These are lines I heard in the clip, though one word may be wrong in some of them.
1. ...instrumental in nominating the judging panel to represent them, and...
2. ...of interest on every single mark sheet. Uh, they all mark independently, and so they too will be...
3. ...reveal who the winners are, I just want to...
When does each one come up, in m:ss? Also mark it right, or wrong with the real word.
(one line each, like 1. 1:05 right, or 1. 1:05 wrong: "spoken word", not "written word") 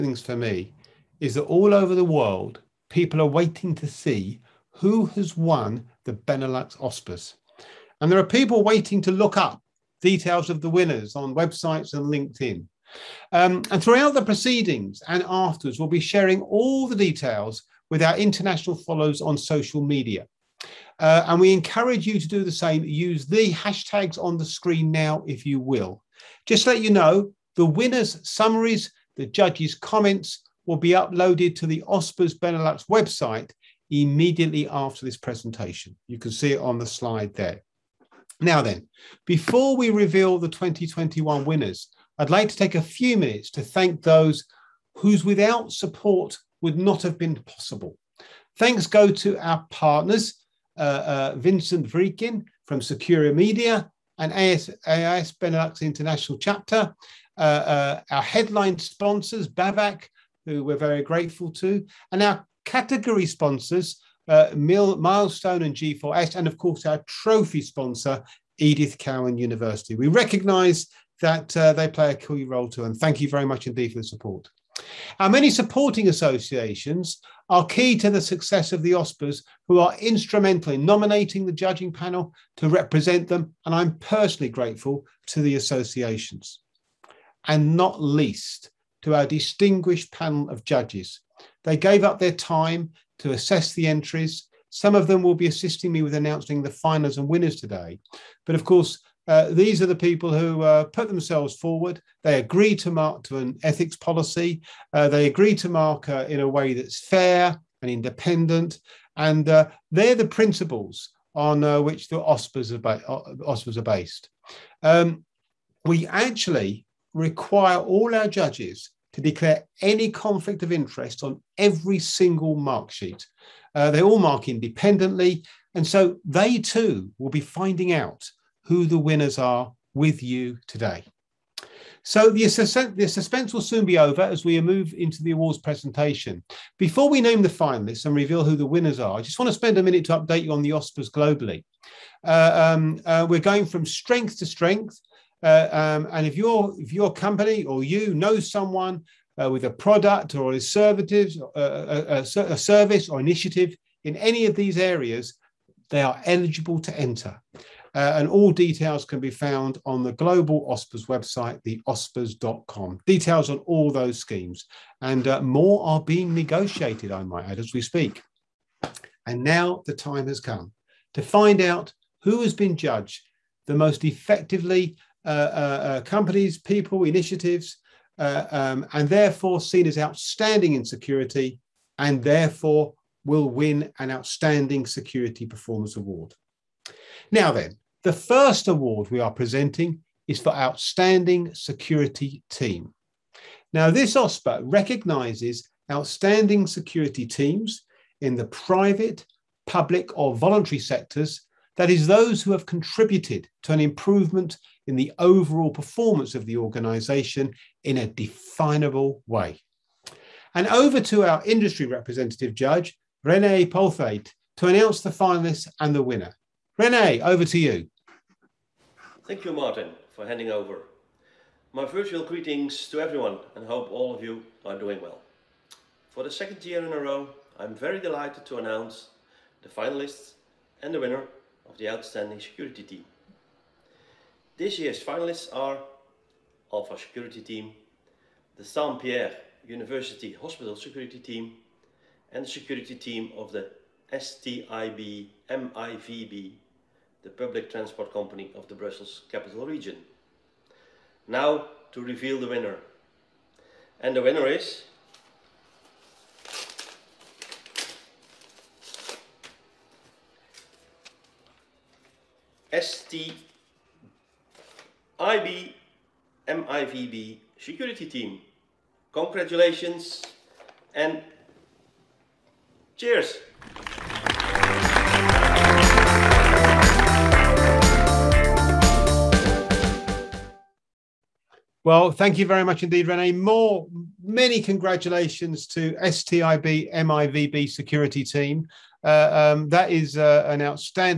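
1. 1:19 right
2. 2:00 right
3. 2:18 right.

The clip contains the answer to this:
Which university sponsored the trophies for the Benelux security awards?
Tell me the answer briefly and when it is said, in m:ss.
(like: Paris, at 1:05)
Edith Cowan University, at 1:08.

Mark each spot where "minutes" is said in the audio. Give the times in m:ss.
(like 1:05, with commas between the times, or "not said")
0:43, 2:19.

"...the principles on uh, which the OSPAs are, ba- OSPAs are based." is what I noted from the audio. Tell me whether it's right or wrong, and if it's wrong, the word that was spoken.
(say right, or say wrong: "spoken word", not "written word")
right.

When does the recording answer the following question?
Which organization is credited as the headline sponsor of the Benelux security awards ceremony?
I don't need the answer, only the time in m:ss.
0:59.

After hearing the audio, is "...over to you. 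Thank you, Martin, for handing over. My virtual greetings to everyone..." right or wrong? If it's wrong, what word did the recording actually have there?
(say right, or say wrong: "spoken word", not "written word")
right.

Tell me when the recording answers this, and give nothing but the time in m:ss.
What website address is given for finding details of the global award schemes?
2:41.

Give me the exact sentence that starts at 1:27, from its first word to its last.
And not least, to our distinguished panel of judges.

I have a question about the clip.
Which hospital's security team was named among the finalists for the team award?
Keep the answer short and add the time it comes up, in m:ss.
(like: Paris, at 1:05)
Saint Pierre University Hospital, at 3:58.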